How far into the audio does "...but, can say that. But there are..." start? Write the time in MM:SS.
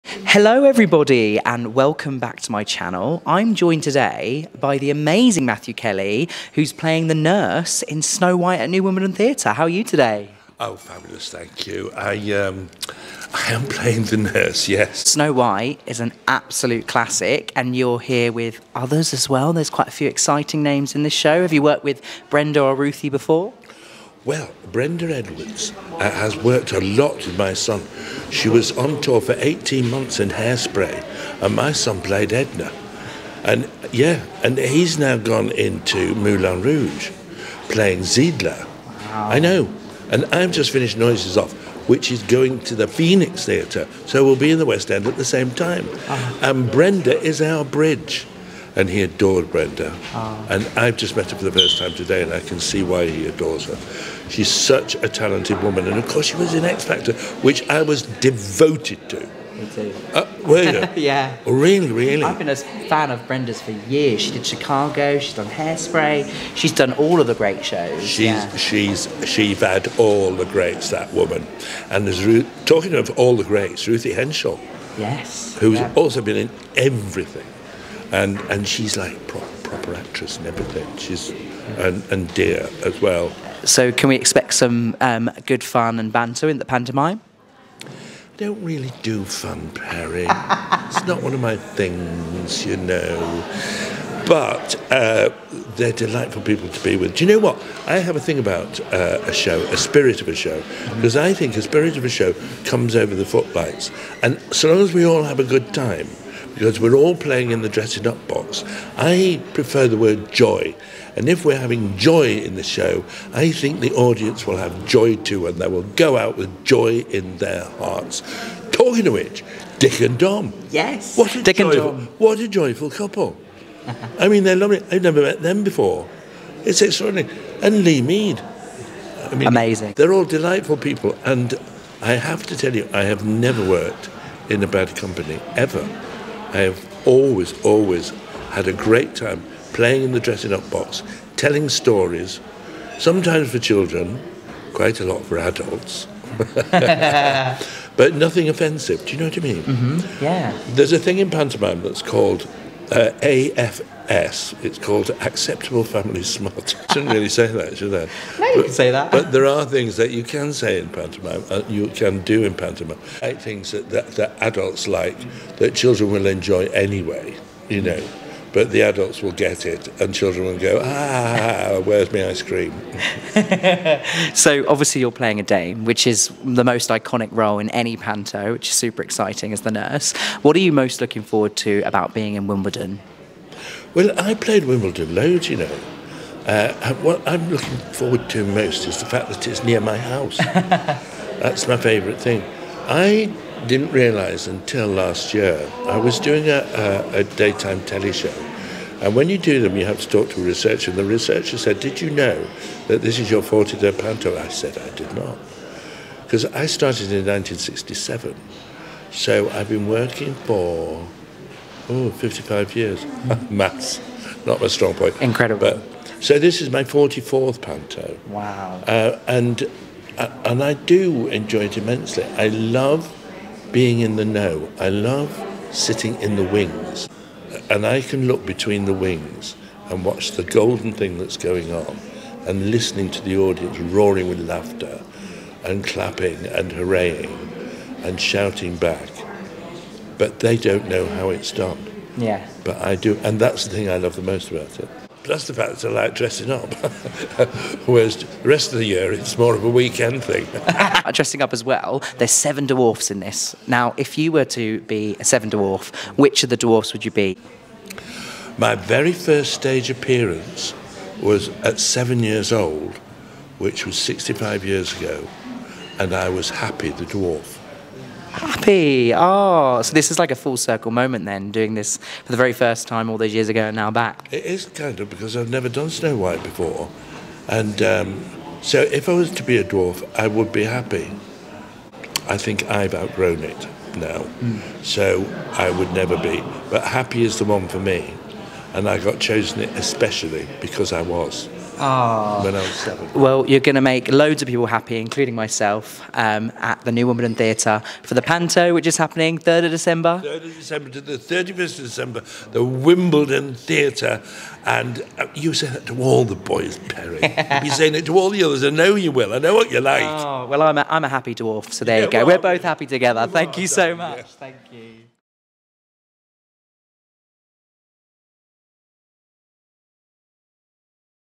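02:38.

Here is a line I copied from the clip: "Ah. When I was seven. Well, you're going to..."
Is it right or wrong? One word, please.
right.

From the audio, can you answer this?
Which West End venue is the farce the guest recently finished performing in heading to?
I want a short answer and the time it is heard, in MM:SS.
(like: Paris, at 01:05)
Phoenix Theatre, at 00:42.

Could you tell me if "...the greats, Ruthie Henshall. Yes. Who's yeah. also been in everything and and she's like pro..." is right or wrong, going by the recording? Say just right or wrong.
right.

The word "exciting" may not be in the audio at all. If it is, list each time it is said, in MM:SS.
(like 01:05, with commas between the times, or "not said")
00:20, 02:59.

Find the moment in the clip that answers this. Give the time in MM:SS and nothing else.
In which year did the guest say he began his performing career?
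03:27.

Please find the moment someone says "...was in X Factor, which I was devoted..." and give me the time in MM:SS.
00:56.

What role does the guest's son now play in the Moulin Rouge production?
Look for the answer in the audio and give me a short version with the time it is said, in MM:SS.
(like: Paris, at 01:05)
Zidler, at 00:38.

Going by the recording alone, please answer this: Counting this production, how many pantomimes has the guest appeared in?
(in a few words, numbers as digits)
44.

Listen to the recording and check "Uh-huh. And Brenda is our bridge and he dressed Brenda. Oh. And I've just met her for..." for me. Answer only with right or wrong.
wrong.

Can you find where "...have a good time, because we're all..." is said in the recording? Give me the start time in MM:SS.
01:45.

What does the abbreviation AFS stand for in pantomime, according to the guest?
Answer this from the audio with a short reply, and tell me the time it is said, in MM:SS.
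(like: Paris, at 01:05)
Acceptable Family Smart, at 02:35.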